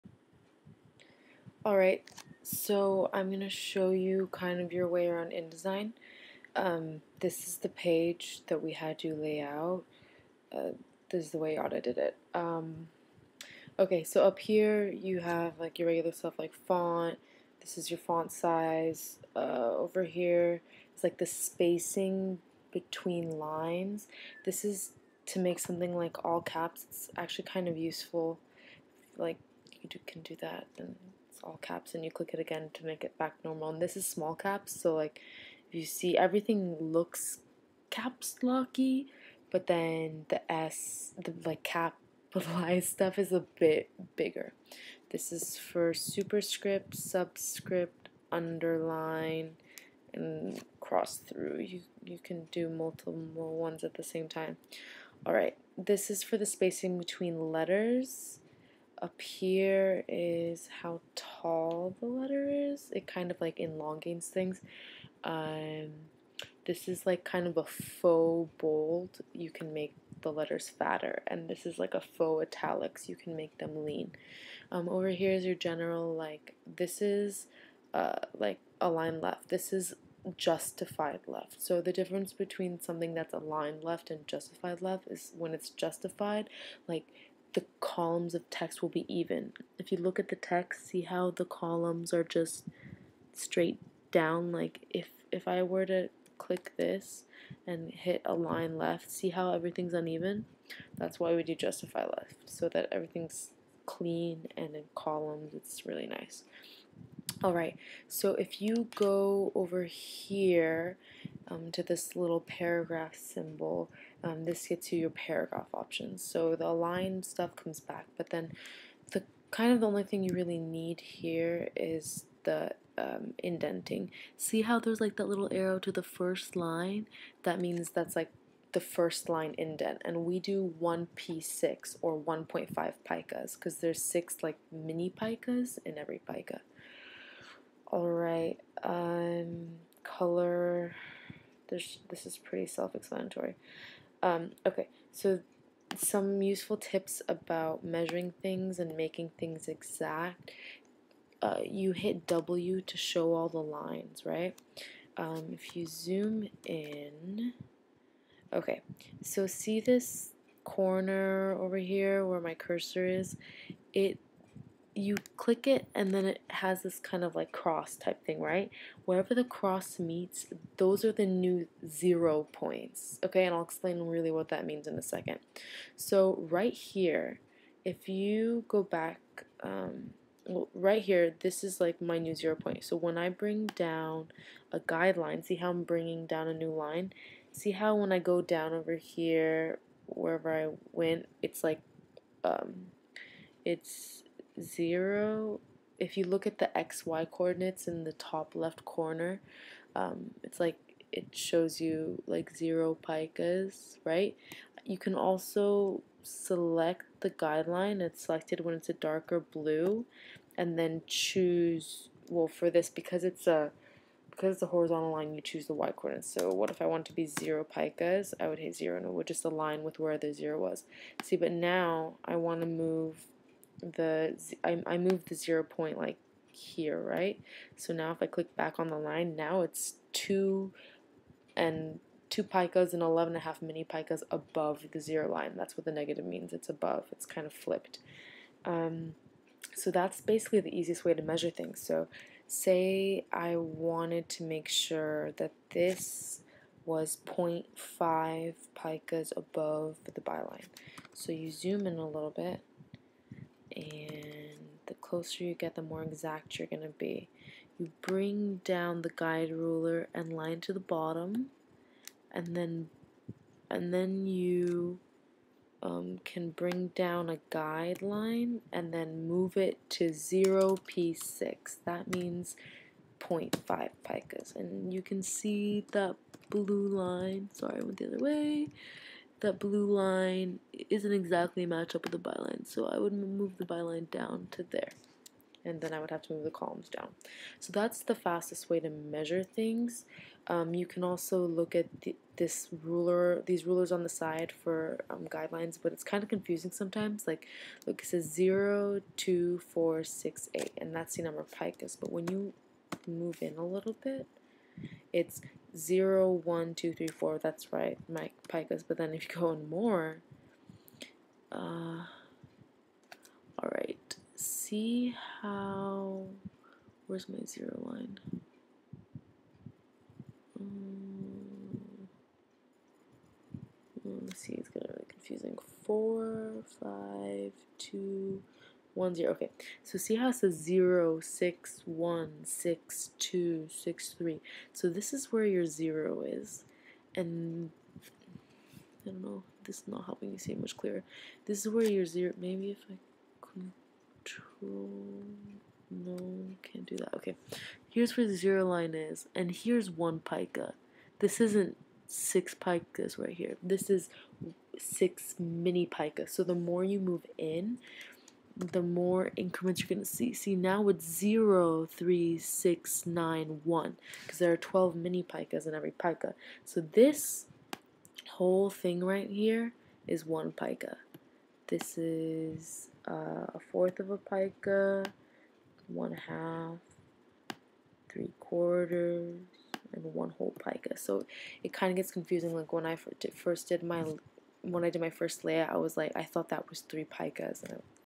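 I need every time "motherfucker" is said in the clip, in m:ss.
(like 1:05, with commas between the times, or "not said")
not said.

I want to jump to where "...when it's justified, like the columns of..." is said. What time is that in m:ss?
1:25.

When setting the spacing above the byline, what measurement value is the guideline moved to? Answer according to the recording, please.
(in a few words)
0p6.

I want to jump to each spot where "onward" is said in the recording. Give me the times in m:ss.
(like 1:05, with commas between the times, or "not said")
not said.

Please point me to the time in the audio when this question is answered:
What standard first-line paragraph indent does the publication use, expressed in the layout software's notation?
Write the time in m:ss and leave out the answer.
2:10.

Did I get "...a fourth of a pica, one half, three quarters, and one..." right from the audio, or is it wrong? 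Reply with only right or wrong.
right.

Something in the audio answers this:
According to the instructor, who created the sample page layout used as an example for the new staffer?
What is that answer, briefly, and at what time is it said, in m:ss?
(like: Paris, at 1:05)
Yada, at 0:11.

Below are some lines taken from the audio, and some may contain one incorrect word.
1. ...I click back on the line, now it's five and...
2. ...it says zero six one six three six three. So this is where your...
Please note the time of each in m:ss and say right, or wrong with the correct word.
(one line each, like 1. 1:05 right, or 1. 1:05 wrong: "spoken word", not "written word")
1. 3:48 wrong: "two", not "five"
2. 5:30 wrong: "two", not "three".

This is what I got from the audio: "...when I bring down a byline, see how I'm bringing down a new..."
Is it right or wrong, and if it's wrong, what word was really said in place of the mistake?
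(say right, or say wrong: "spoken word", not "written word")
wrong: "guideline", not "byline".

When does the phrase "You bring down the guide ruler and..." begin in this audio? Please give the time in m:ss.
4:17.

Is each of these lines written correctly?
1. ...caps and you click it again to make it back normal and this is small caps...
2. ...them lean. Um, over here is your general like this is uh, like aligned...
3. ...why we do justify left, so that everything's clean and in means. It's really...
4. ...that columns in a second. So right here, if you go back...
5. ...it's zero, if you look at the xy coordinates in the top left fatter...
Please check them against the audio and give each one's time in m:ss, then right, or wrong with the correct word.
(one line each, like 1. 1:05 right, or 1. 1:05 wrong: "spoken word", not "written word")
1. 0:31 right
2. 1:13 right
3. 1:41 wrong: "columns", not "means"
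4. 2:54 wrong: "means", not "columns"
5. 3:13 wrong: "corner", not "fatter".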